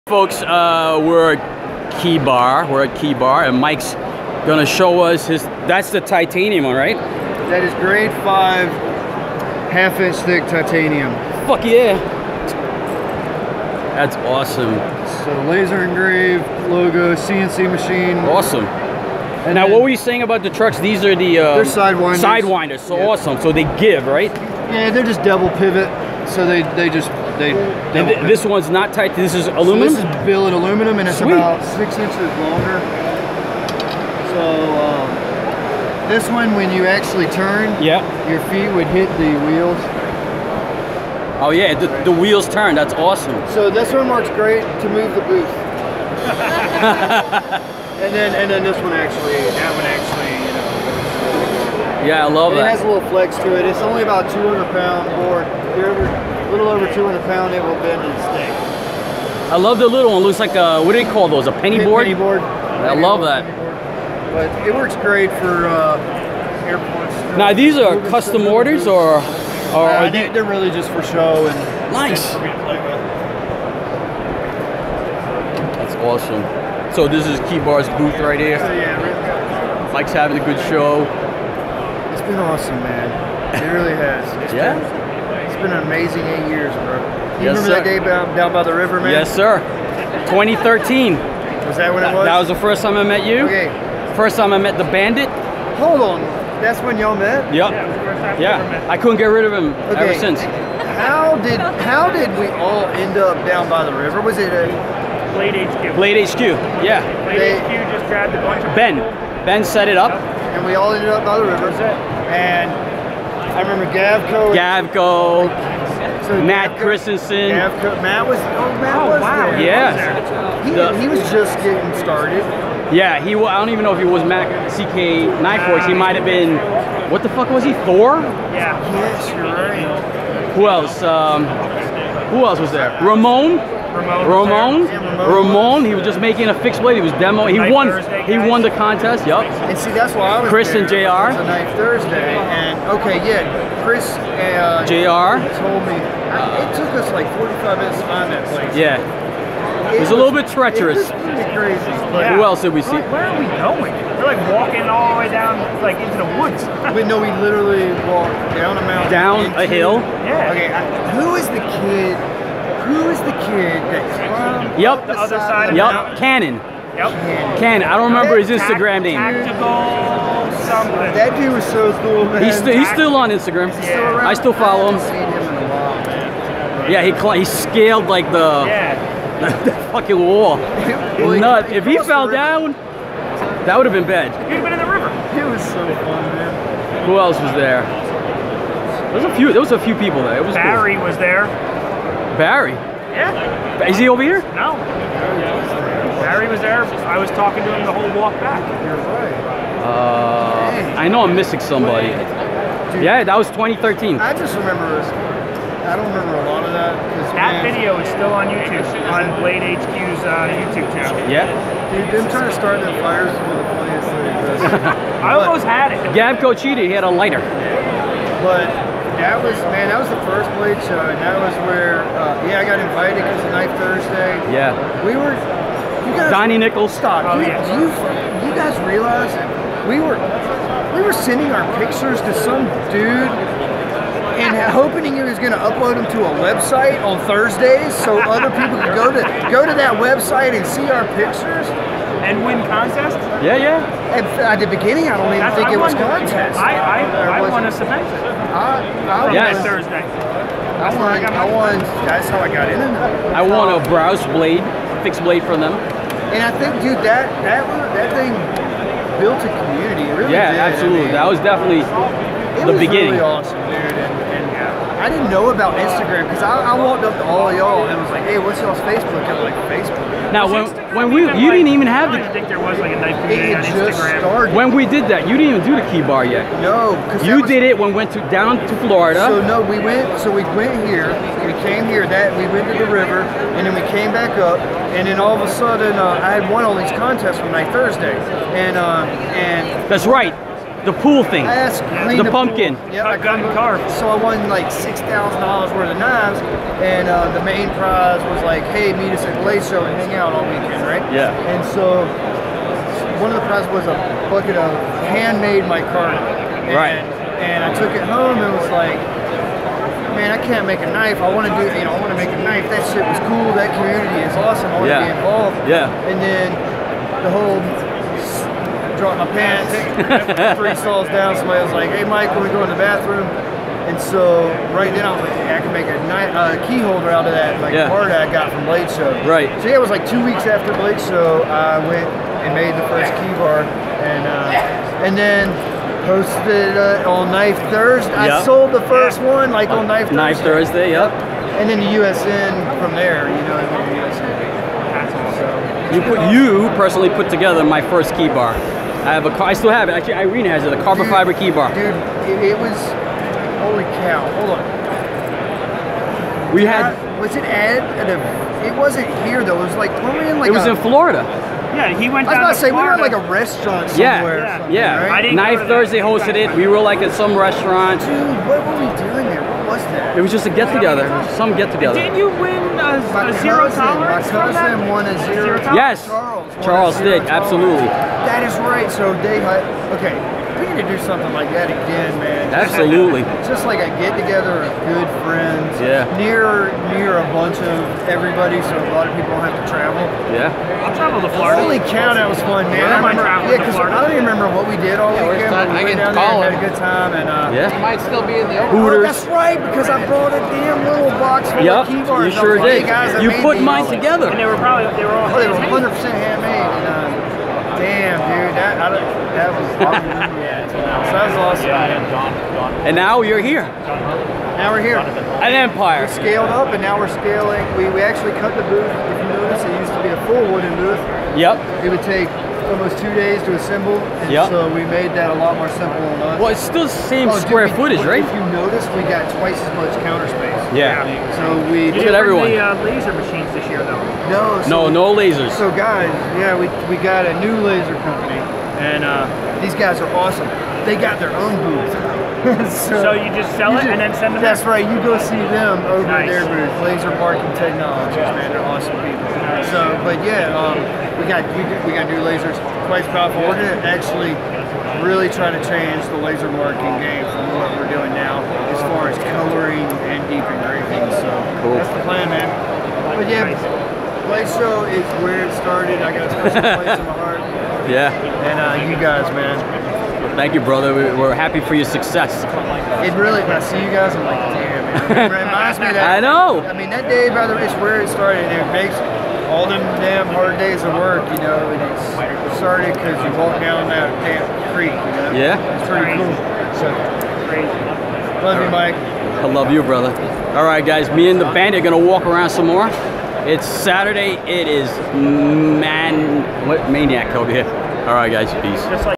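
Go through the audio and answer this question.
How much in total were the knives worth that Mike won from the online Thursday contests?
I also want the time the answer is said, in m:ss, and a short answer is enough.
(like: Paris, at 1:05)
$6,000, at 4:54.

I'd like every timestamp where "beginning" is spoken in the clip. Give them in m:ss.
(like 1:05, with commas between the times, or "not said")
4:04, 4:22.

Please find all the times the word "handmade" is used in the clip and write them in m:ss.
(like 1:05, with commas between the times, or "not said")
5:05, 6:46.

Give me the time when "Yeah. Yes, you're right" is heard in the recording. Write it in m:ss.
2:08.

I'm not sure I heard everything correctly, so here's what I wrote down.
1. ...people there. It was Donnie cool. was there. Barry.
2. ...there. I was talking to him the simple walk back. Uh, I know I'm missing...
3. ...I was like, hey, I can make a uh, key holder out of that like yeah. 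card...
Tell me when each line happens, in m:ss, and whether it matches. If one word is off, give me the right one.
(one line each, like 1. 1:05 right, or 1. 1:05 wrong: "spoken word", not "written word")
1. 3:09 wrong: "Barry", not "Donnie"
2. 3:16 wrong: "whole", not "simple"
3. 5:25 right.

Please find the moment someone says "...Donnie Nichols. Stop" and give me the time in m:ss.
3:46.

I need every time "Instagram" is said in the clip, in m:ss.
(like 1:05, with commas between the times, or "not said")
2:48, 2:53, 4:25, 4:33.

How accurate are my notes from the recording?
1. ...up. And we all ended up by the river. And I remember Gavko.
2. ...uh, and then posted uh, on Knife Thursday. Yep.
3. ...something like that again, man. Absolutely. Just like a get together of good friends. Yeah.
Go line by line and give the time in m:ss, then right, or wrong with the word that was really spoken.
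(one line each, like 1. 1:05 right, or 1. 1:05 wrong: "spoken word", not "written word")
1. 1:49 right
2. 5:34 right
3. 6:21 right.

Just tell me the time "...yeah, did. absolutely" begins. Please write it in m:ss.
4:20.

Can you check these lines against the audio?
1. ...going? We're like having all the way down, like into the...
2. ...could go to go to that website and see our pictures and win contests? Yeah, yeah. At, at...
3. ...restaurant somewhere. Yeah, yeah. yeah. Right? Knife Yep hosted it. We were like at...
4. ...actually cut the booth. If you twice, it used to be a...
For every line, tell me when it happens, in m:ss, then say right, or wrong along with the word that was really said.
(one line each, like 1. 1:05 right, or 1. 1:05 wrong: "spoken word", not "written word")
1. 2:33 wrong: "walking", not "having"
2. 3:58 right
3. 6:03 wrong: "Thursday", not "Yep"
4. 6:58 wrong: "notice", not "twice".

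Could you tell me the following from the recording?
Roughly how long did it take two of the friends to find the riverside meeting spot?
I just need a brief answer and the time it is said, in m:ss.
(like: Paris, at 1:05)
45 minutes, at 2:27.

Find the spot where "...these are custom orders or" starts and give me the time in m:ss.
1:07.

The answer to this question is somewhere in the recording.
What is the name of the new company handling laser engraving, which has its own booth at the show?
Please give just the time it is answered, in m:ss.
7:26.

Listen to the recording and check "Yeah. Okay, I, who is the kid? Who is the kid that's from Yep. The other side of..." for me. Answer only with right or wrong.
right.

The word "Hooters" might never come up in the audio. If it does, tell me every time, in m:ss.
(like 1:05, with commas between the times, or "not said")
6:38.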